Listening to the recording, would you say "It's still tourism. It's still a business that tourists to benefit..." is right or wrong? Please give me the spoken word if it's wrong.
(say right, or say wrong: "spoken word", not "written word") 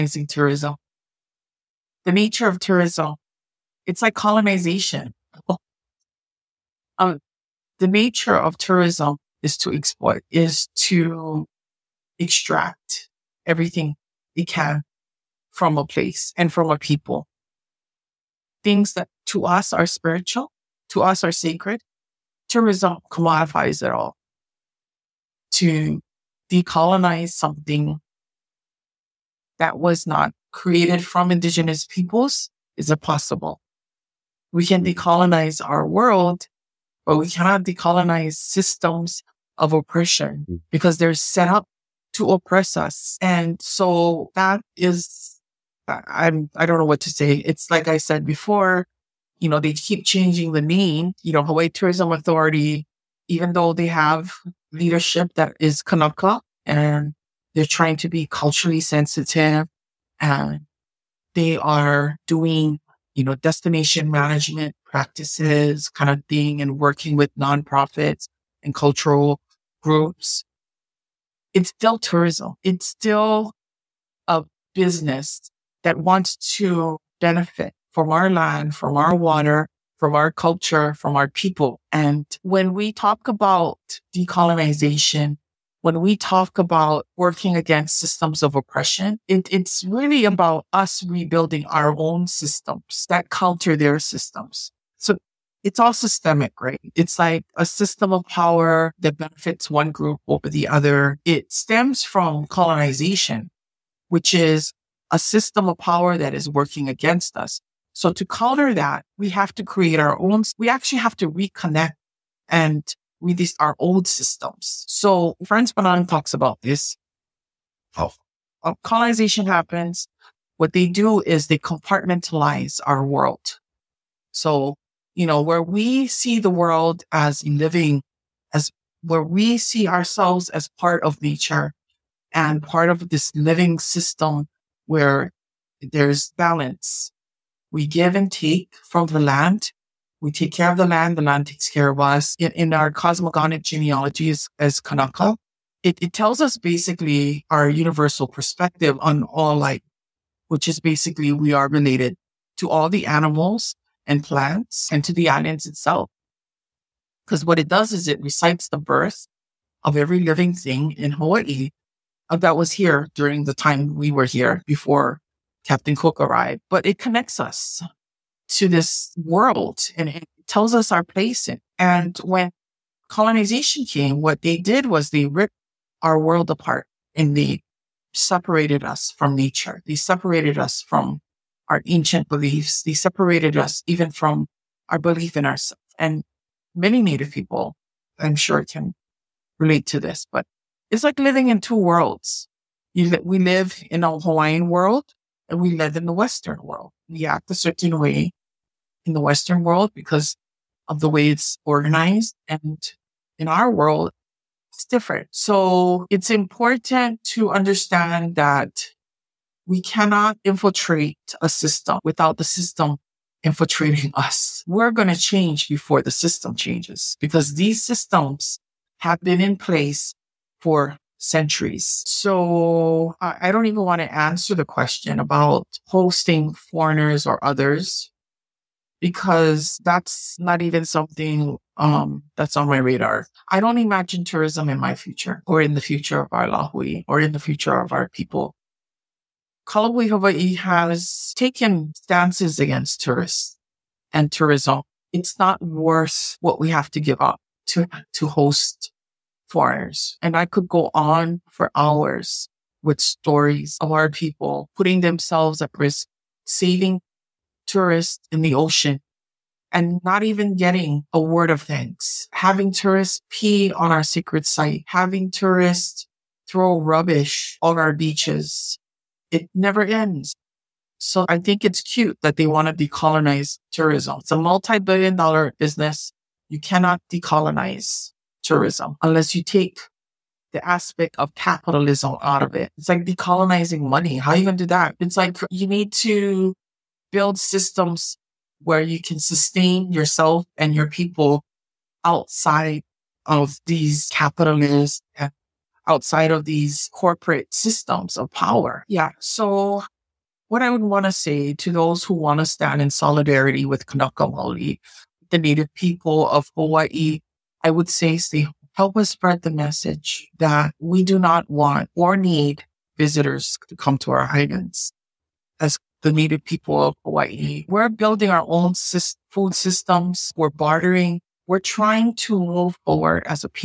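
wrong: "wants", not "tourists".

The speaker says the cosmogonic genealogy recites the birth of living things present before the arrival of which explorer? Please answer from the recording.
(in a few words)
Captain Cook.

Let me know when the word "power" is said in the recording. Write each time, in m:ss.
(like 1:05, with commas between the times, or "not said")
1:38, 1:45, 4:58.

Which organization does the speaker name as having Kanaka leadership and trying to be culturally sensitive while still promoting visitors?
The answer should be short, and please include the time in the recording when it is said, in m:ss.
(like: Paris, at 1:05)
Hawaii Tourism Authority, at 0:51.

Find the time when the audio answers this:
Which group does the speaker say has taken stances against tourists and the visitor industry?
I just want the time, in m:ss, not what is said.
3:59.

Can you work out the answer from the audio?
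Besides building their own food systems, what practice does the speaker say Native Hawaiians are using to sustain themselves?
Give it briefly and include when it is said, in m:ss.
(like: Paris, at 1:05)
Bartering, at 5:20.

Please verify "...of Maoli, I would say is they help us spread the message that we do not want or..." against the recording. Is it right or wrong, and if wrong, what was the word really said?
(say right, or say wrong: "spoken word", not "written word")
wrong: "Hawaii", not "Maoli".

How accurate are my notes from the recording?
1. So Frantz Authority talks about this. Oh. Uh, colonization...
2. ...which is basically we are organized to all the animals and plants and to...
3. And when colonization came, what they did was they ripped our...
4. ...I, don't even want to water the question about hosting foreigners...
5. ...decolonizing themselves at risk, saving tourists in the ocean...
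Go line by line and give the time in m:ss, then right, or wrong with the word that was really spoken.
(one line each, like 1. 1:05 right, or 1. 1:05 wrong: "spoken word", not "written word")
1. 1:54 wrong: "Fanon", not "Authority"
2. 2:30 wrong: "related", not "organized"
3. 2:51 right
4. 3:43 wrong: "answer", not "water"
5. 4:14 wrong: "putting", not "decolonizing".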